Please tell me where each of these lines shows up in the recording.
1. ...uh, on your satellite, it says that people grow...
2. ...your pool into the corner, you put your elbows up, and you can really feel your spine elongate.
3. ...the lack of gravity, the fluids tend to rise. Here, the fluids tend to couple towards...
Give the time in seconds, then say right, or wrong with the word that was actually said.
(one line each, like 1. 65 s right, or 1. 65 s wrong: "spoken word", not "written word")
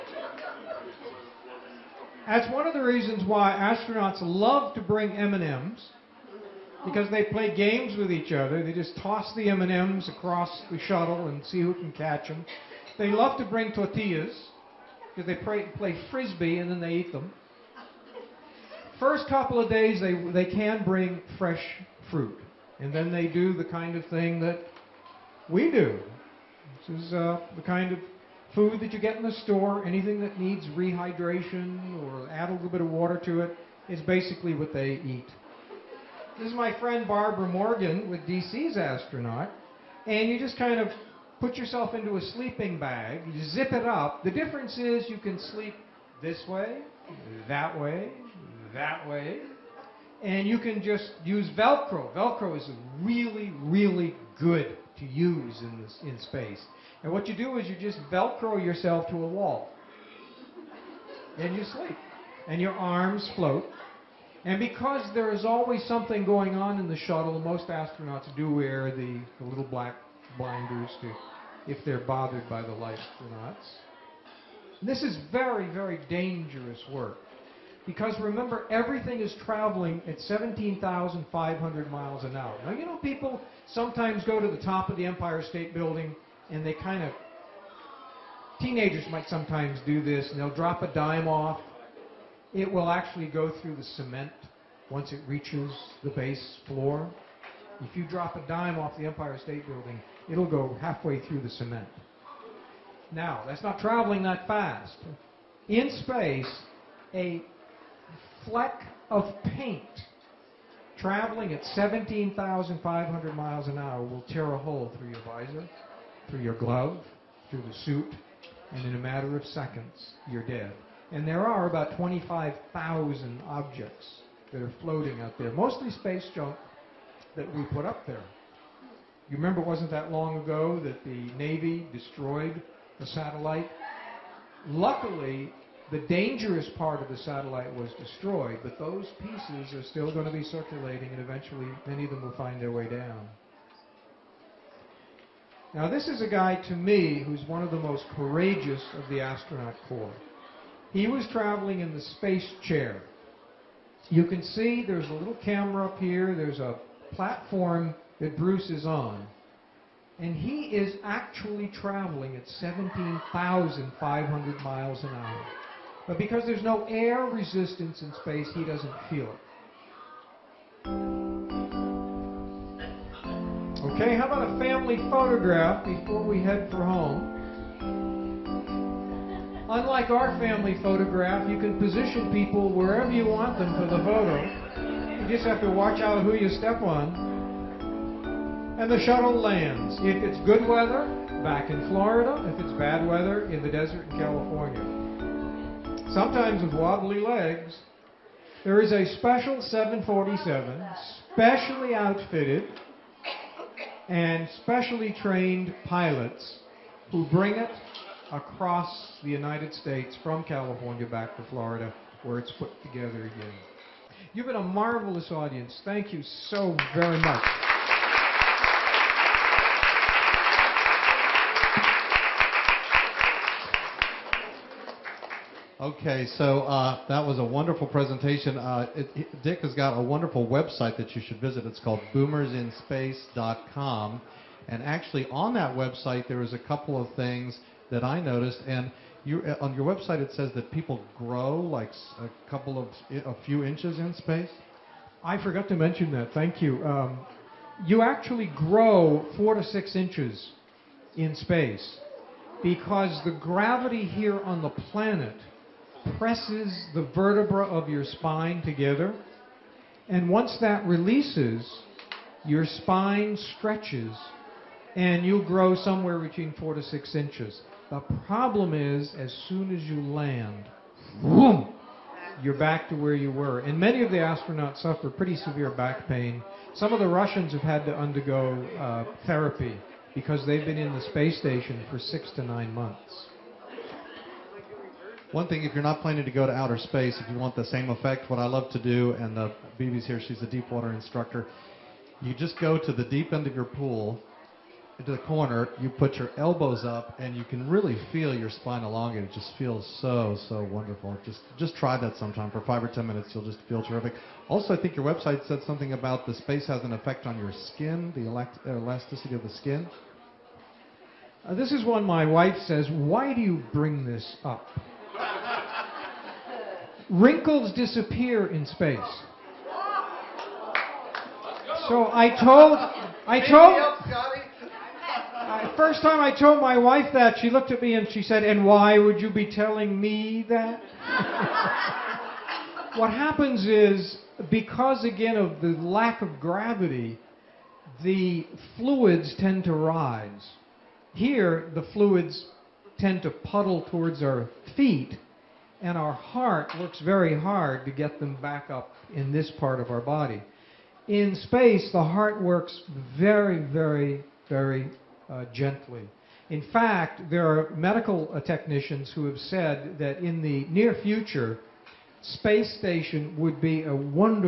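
1. 239 s wrong: "website", not "satellite"
2. 293 s right
3. 335 s wrong: "puddle", not "couple".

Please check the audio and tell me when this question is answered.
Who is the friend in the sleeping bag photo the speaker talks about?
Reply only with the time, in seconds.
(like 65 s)
37 s.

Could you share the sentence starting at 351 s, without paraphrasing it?
In space, the heart works very, very, very uh, gently.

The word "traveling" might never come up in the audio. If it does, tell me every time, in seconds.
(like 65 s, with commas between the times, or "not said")
79 s, 103 s, 110 s, 151 s, 161 s.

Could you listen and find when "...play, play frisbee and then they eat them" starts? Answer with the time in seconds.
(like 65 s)
15 s.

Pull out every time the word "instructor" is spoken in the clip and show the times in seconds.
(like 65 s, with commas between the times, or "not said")
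290 s.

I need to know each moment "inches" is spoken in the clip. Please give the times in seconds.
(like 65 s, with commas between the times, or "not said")
243 s, 249 s, 267 s.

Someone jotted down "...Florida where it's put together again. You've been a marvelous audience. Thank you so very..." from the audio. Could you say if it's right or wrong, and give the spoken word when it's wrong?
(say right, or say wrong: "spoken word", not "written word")
right.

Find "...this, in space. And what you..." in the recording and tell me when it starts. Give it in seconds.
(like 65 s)
55 s.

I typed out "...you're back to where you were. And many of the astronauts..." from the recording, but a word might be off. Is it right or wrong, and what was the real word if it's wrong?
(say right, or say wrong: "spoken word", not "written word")
right.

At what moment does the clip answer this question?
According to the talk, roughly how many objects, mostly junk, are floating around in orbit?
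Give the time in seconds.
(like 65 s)
121 s.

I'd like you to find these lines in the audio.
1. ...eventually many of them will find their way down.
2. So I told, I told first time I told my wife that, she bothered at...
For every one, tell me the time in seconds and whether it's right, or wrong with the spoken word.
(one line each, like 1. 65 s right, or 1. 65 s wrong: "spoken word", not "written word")
1. 141 s right
2. 321 s wrong: "looked", not "bothered".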